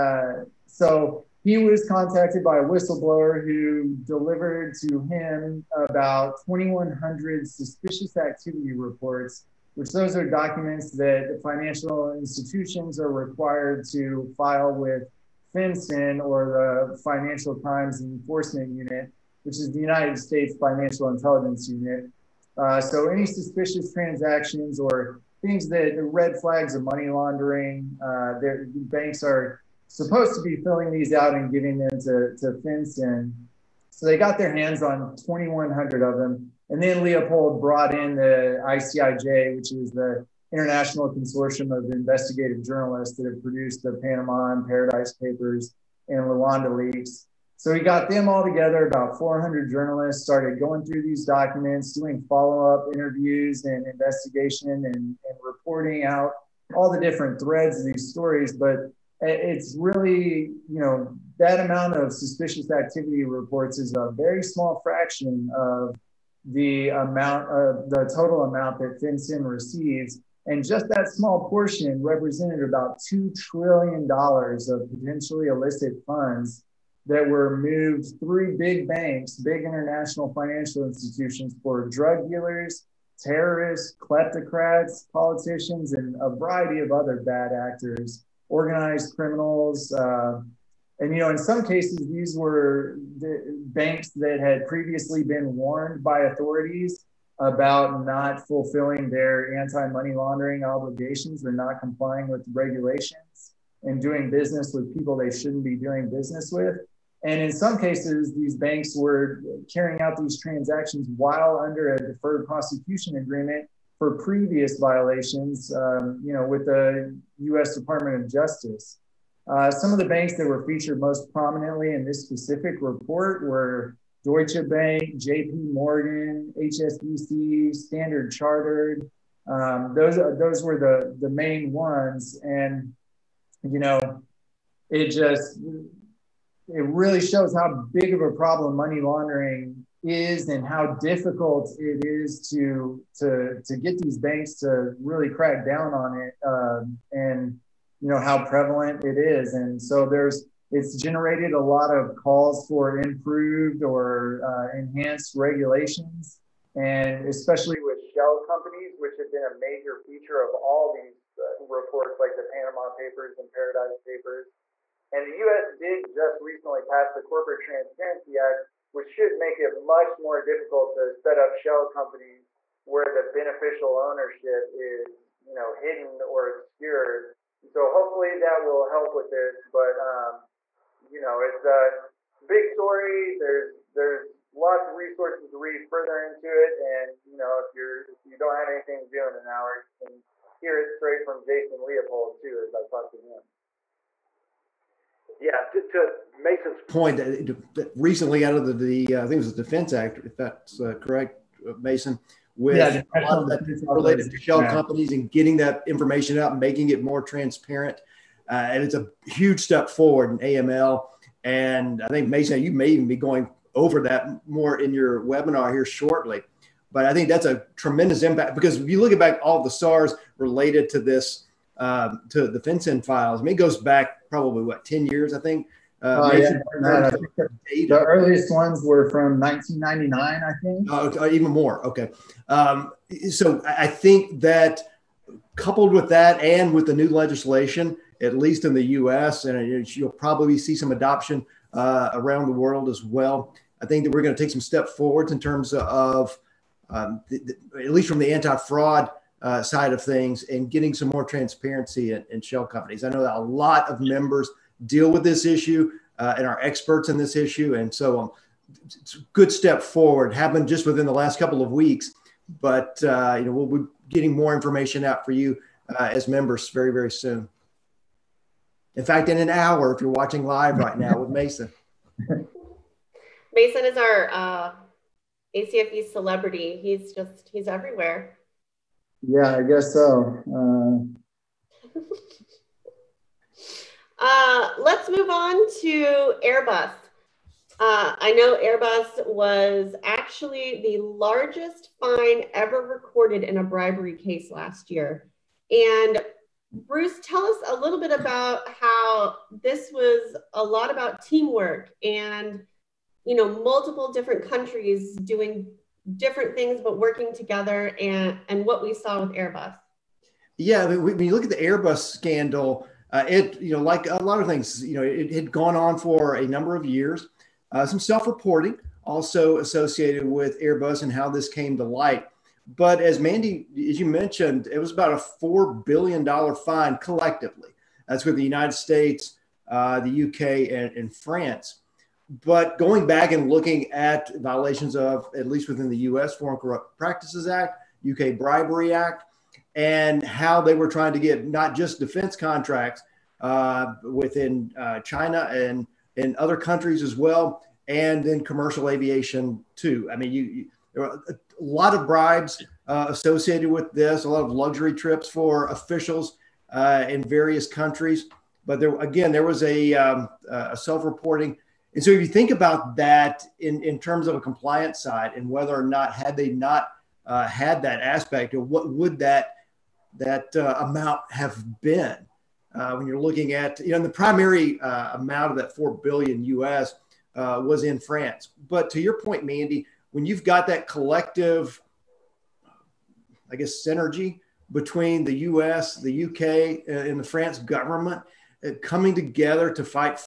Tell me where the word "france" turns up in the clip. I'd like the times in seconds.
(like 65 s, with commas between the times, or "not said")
331 s, 377 s, 387 s.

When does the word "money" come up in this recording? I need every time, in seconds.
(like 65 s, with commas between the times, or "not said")
26 s, 99 s, 138 s.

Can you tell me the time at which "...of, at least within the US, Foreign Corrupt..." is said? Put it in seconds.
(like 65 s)
334 s.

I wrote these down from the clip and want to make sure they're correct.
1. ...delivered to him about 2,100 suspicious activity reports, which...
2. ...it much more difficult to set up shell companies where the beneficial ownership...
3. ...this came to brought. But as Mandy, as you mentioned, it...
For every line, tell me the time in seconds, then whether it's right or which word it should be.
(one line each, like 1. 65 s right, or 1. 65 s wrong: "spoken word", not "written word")
1. 4 s right
2. 169 s right
3. 321 s wrong: "light", not "brought".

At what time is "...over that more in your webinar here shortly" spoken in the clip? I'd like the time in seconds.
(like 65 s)
213 s.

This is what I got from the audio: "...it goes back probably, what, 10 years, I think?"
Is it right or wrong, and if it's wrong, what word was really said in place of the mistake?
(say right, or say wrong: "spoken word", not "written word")
right.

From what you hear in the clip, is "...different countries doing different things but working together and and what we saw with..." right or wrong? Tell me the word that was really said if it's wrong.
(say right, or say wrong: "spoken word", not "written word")
right.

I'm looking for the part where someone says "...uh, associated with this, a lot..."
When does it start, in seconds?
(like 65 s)
352 s.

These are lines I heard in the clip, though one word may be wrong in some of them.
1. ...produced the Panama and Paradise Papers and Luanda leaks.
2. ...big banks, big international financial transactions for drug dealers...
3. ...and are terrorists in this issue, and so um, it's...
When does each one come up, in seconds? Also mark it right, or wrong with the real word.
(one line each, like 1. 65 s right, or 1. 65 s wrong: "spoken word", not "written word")
1. 43 s right
2. 78 s wrong: "institutions", not "transactions"
3. 256 s wrong: "experts", not "terrorists".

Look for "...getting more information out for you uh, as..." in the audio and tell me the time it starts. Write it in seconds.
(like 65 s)
264 s.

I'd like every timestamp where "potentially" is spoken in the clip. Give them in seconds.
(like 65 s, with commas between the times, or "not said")
74 s.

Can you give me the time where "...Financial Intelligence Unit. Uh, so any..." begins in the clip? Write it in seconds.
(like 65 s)
20 s.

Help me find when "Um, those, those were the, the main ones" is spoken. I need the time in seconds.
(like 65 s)
129 s.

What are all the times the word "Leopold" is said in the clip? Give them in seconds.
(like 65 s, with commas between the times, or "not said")
37 s, 191 s.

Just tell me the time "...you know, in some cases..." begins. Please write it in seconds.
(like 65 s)
91 s.